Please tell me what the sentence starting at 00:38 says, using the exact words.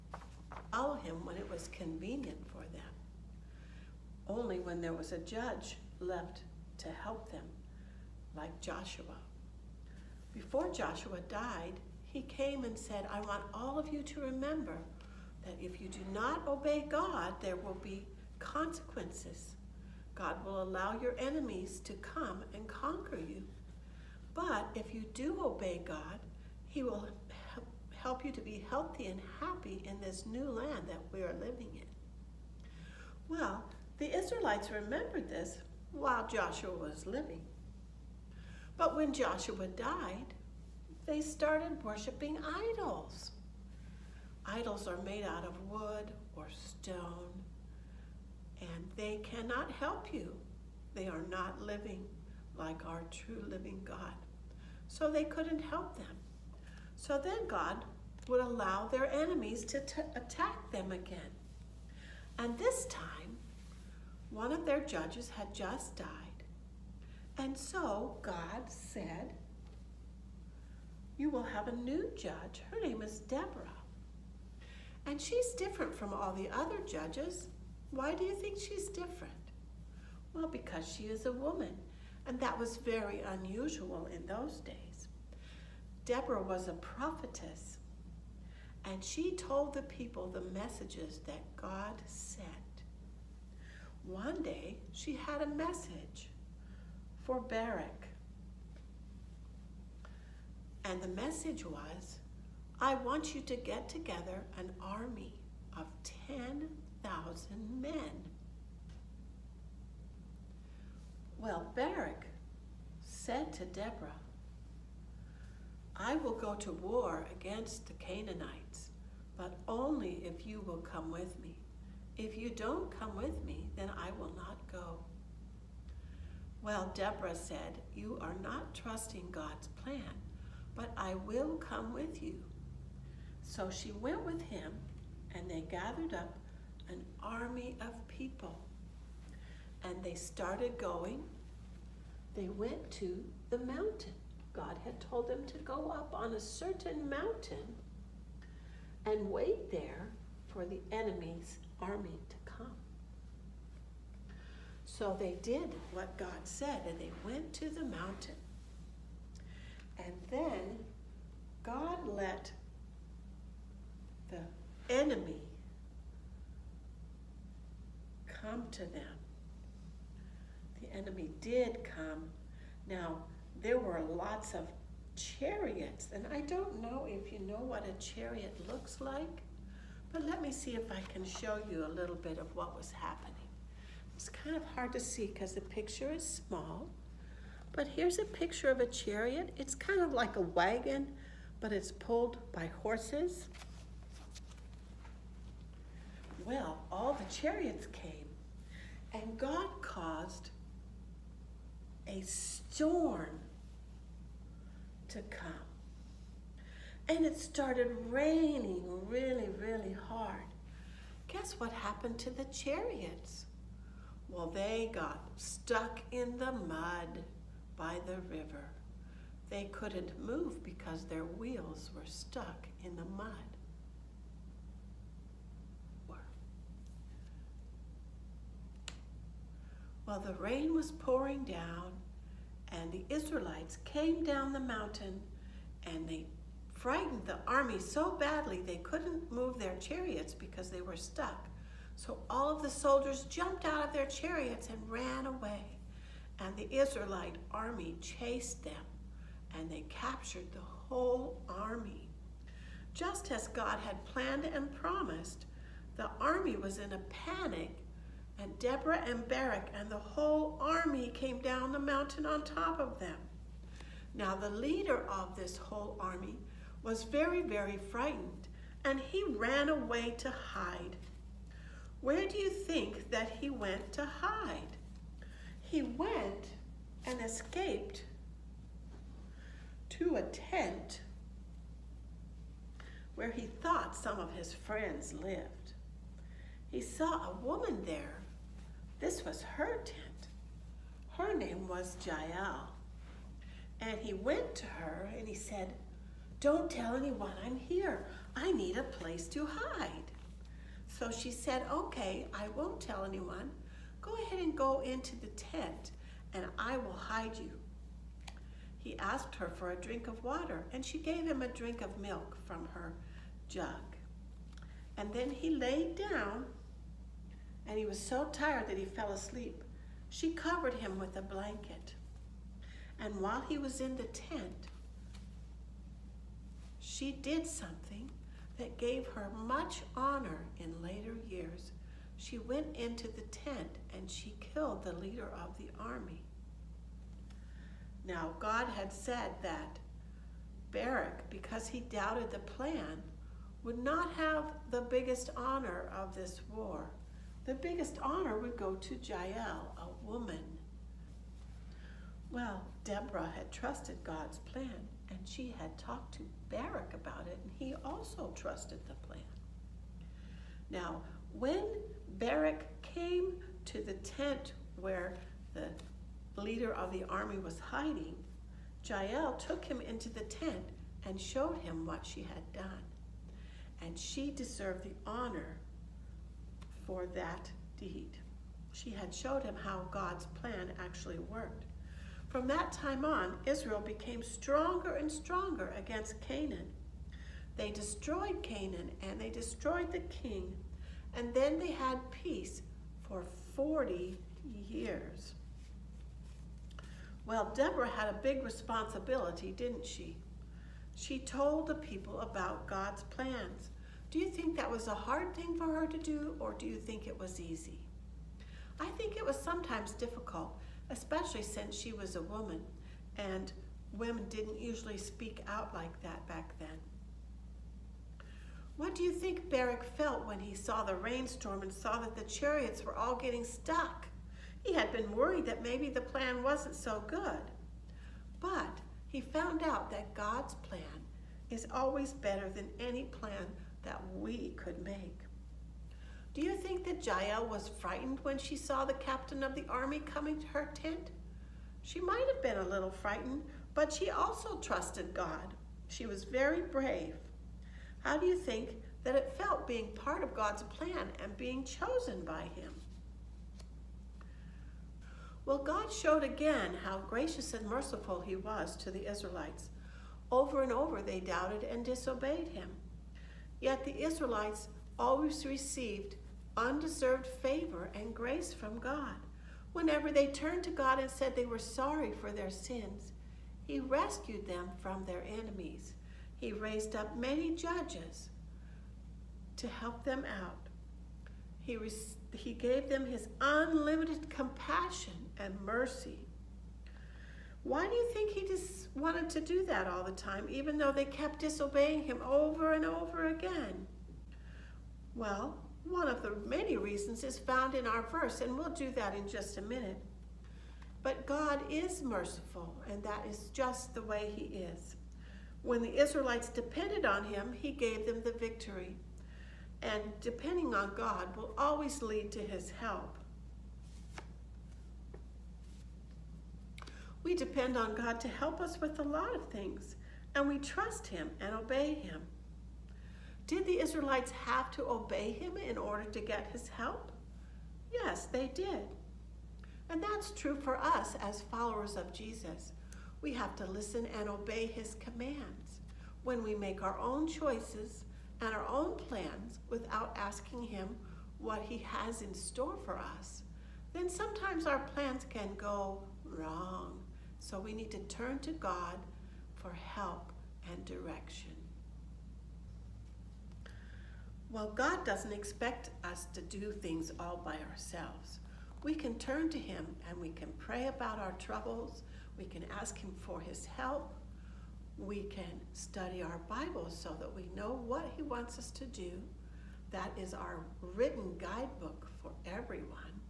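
But when Joshua died, they started worshiping idols.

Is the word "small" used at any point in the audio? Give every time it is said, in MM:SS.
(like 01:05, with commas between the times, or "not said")
03:06.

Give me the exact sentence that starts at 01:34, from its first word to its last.
One day, she had a message for Barak.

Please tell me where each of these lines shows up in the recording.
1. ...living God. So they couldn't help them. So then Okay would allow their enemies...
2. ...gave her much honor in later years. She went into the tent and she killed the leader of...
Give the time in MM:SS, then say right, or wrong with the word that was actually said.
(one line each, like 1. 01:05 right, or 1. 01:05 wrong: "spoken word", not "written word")
1. 00:53 wrong: "God", not "Okay"
2. 05:28 right.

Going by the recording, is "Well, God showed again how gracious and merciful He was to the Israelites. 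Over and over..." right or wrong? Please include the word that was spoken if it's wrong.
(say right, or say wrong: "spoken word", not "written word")
right.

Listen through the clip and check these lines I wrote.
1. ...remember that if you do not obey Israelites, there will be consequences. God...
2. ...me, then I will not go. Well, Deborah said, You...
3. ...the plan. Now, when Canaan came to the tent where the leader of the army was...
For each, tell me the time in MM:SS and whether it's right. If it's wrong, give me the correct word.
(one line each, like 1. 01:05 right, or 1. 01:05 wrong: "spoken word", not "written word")
1. 00:14 wrong: "God", not "Israelites"
2. 02:03 right
3. 05:58 wrong: "Barak", not "Canaan".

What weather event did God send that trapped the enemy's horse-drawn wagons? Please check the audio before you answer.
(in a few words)
A storm.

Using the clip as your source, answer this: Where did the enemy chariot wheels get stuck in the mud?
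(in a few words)
By the river.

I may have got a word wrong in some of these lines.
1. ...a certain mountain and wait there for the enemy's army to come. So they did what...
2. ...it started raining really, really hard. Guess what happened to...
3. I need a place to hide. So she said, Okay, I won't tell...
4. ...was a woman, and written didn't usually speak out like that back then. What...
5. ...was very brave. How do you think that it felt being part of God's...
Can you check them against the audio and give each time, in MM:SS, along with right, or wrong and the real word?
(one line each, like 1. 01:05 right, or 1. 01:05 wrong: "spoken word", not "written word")
1. 02:26 right
2. 03:27 right
3. 04:58 right
4. 06:51 wrong: "women", not "written"
5. 07:26 right.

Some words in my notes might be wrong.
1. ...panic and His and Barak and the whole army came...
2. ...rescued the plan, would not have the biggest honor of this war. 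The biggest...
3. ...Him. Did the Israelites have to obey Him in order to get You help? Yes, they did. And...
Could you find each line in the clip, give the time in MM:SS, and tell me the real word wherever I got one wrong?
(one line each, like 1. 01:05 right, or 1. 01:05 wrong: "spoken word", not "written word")
1. 04:17 wrong: "Deborah", not "His"
2. 05:41 wrong: "doubted", not "rescued"
3. 08:41 wrong: "His", not "You".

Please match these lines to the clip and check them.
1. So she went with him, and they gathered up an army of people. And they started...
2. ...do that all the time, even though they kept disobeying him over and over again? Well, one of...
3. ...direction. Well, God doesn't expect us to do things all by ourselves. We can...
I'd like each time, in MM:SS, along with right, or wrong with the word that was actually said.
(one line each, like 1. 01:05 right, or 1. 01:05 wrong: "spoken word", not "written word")
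1. 02:13 right
2. 08:09 right
3. 09:10 right.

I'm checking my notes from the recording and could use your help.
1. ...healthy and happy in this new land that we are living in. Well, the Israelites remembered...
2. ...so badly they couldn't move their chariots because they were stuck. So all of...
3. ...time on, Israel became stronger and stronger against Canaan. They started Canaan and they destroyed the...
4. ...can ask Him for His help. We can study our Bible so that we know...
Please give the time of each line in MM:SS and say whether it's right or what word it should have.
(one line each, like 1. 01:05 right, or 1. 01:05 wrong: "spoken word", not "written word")
1. 00:28 right
2. 03:57 right
3. 06:22 wrong: "destroyed", not "started"
4. 09:22 right.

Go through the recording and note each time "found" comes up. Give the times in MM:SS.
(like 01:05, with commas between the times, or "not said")
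07:09, 08:17.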